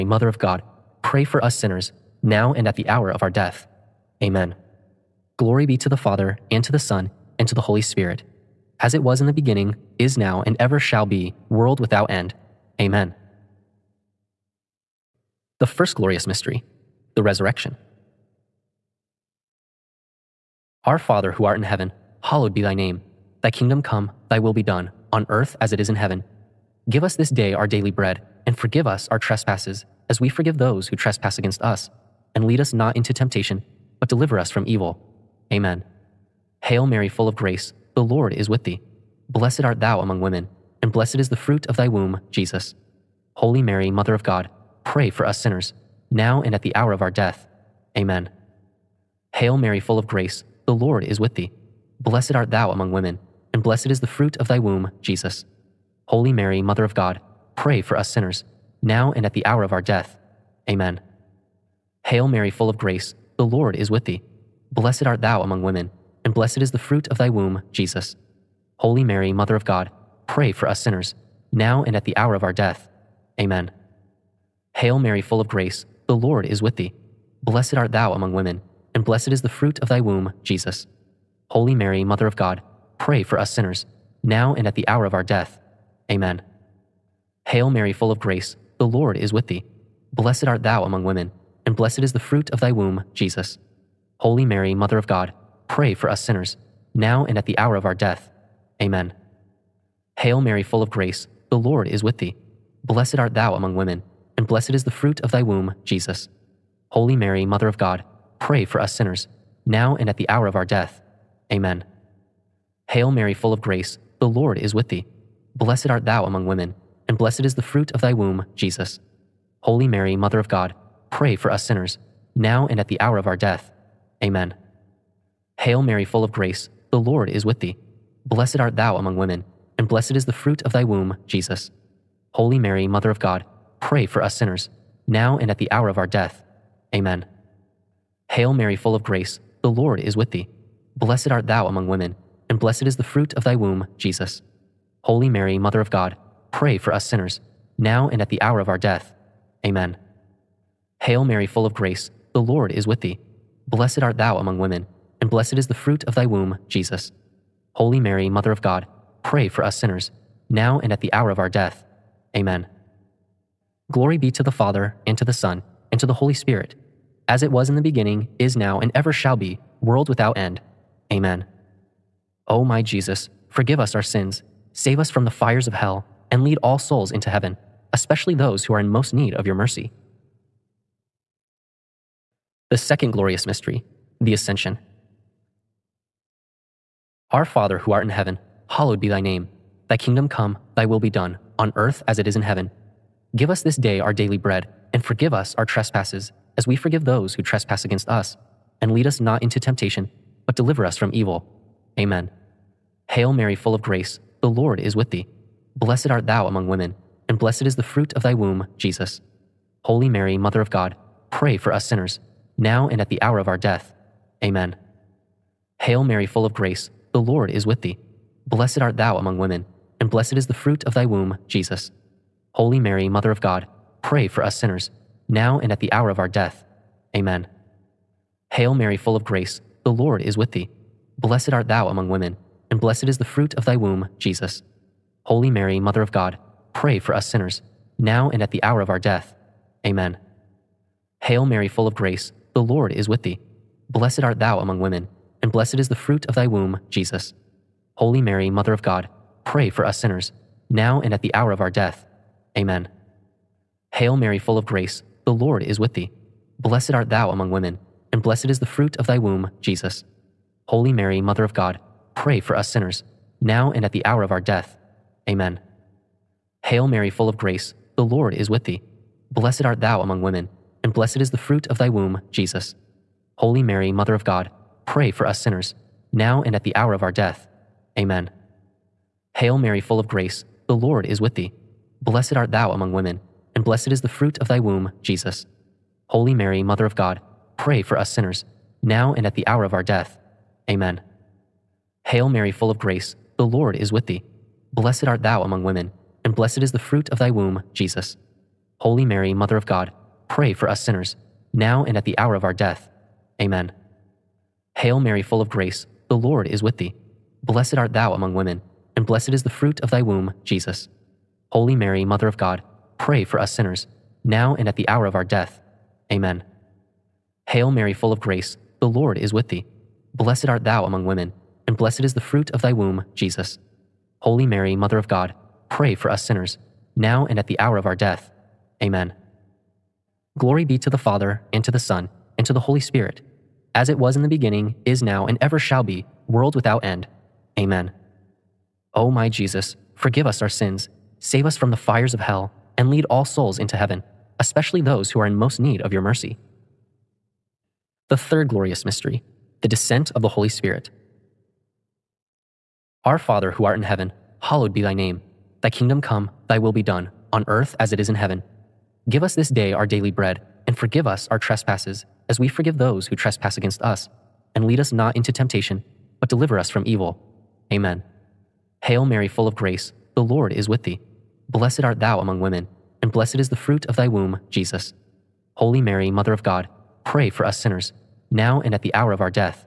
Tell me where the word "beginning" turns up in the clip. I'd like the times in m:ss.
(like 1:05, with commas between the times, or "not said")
0:09, 2:47, 5:34.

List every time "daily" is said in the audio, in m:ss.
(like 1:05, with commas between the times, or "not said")
0:27, 3:14, 5:59.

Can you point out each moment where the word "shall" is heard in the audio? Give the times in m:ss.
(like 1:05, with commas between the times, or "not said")
0:10, 2:49, 5:35.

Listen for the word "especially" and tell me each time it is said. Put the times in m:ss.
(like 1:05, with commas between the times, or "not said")
2:57, 5:44.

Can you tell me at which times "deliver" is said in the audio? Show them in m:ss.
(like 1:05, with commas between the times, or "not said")
0:34, 3:20, 6:06.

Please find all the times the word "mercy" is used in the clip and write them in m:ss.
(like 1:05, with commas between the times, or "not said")
2:59, 5:45.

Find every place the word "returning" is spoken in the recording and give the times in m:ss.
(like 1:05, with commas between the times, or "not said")
not said.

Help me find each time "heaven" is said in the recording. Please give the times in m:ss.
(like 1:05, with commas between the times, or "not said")
0:21, 0:25, 2:57, 3:08, 3:12, 5:43, 5:53, 5:58.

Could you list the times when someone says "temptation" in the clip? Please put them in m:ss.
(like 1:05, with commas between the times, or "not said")
0:33, 3:19, 6:05.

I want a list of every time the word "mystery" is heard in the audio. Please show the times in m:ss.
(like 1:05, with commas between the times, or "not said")
0:16, 3:03, 5:48.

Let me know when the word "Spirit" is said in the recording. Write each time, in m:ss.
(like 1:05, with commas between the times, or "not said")
0:07, 2:46, 5:32, 5:50.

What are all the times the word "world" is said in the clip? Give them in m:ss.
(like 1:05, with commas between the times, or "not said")
0:11, 2:49, 5:36.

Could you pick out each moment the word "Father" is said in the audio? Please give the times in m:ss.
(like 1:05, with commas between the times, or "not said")
0:05, 0:20, 2:44, 3:07, 5:30, 5:53.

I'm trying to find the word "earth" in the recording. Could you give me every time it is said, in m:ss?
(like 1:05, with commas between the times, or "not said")
0:25, 3:11, 5:57.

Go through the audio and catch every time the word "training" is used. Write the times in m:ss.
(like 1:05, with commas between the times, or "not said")
not said.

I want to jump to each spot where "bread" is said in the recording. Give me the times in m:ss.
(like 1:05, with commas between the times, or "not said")
0:27, 3:14, 6:00.